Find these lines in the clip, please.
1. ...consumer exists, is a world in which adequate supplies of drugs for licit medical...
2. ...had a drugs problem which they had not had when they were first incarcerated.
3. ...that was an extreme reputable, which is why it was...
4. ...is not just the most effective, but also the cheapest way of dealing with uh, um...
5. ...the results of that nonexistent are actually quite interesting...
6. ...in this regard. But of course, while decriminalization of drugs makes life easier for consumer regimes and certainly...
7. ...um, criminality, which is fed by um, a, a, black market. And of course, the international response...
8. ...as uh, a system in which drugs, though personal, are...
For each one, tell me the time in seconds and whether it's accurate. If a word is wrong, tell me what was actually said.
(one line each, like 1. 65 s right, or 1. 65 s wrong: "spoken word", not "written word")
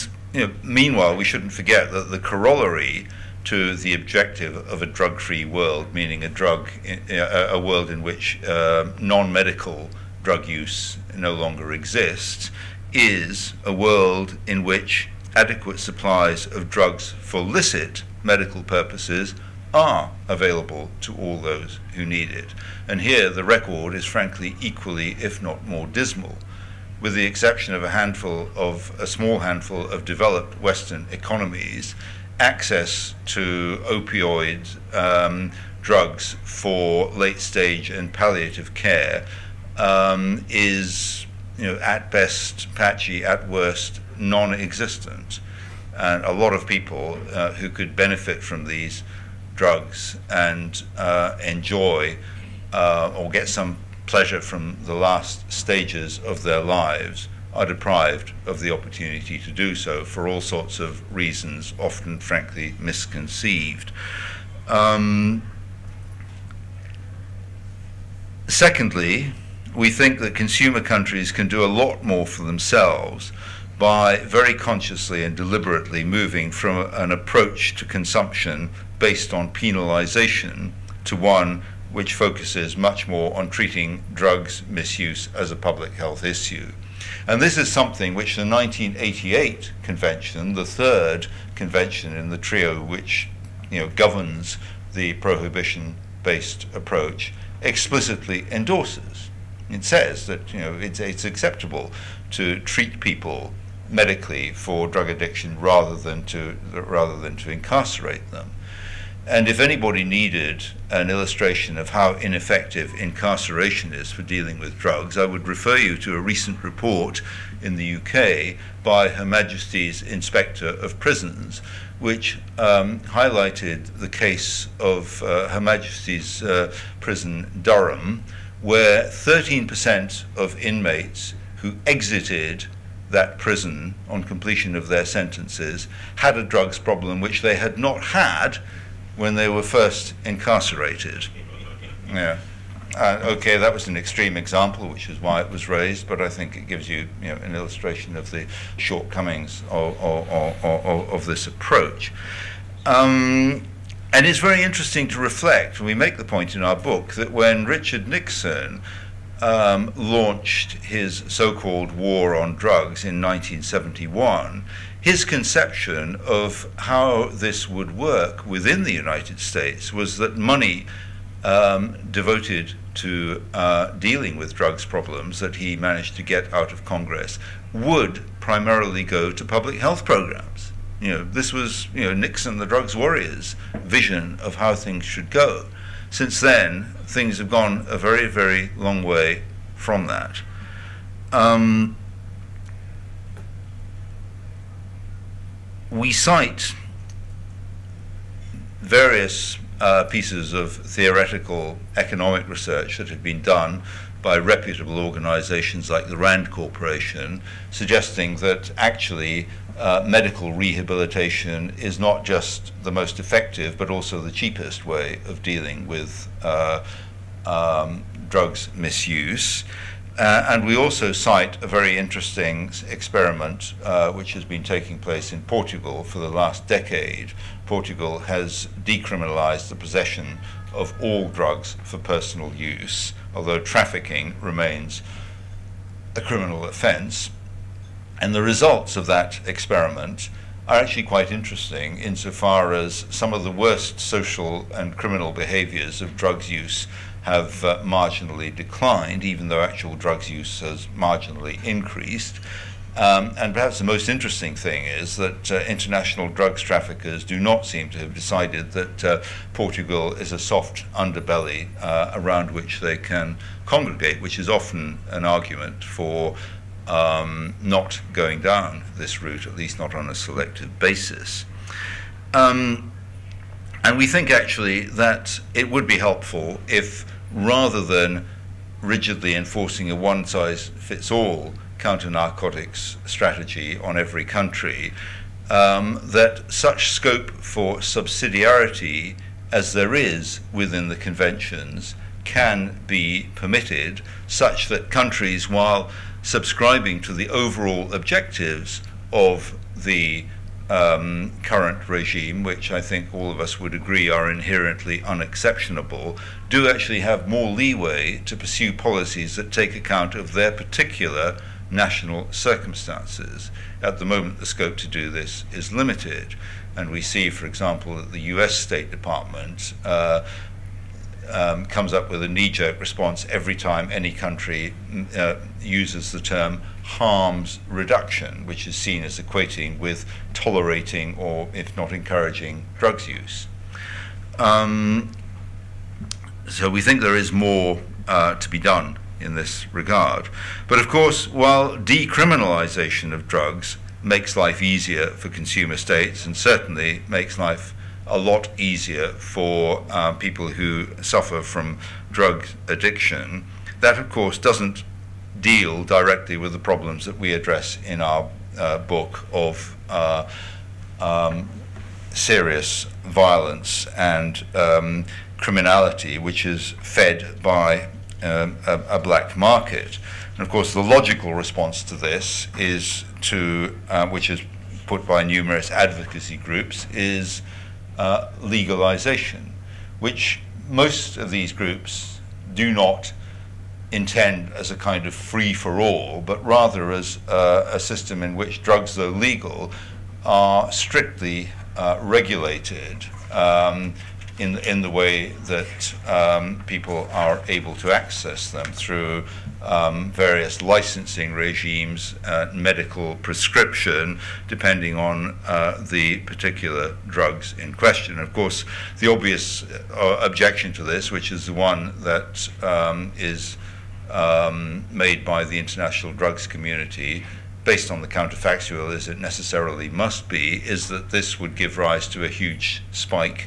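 1. 11 s wrong: "longer", not "consumer"
2. 136 s right
3. 143 s wrong: "example", not "reputable"
4. 211 s right
5. 238 s wrong: "experiment", not "nonexistent"
6. 339 s wrong: "states", not "regimes"
7. 364 s wrong: "logical", not "international"
8. 386 s wrong: "legal", not "personal".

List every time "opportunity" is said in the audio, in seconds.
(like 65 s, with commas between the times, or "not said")
58 s.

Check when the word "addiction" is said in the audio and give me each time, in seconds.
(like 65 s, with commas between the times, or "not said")
105 s, 352 s.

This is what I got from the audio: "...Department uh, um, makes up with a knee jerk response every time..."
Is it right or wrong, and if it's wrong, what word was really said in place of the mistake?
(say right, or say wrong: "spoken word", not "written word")
wrong: "comes", not "makes".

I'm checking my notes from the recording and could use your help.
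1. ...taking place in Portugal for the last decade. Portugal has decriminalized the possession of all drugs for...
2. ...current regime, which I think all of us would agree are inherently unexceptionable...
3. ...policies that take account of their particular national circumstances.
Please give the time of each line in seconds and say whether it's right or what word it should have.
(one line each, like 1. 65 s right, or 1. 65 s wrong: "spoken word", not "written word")
1. 224 s right
2. 301 s right
3. 308 s right.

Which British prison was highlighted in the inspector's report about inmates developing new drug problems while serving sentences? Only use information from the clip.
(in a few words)
Durham.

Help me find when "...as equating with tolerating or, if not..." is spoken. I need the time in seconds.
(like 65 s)
329 s.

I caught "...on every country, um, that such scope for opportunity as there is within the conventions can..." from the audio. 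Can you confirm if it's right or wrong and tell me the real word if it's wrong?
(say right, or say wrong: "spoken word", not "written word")
wrong: "subsidiarity", not "opportunity".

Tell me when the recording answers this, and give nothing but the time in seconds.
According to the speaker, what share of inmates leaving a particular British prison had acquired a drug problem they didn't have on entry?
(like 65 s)
129 s.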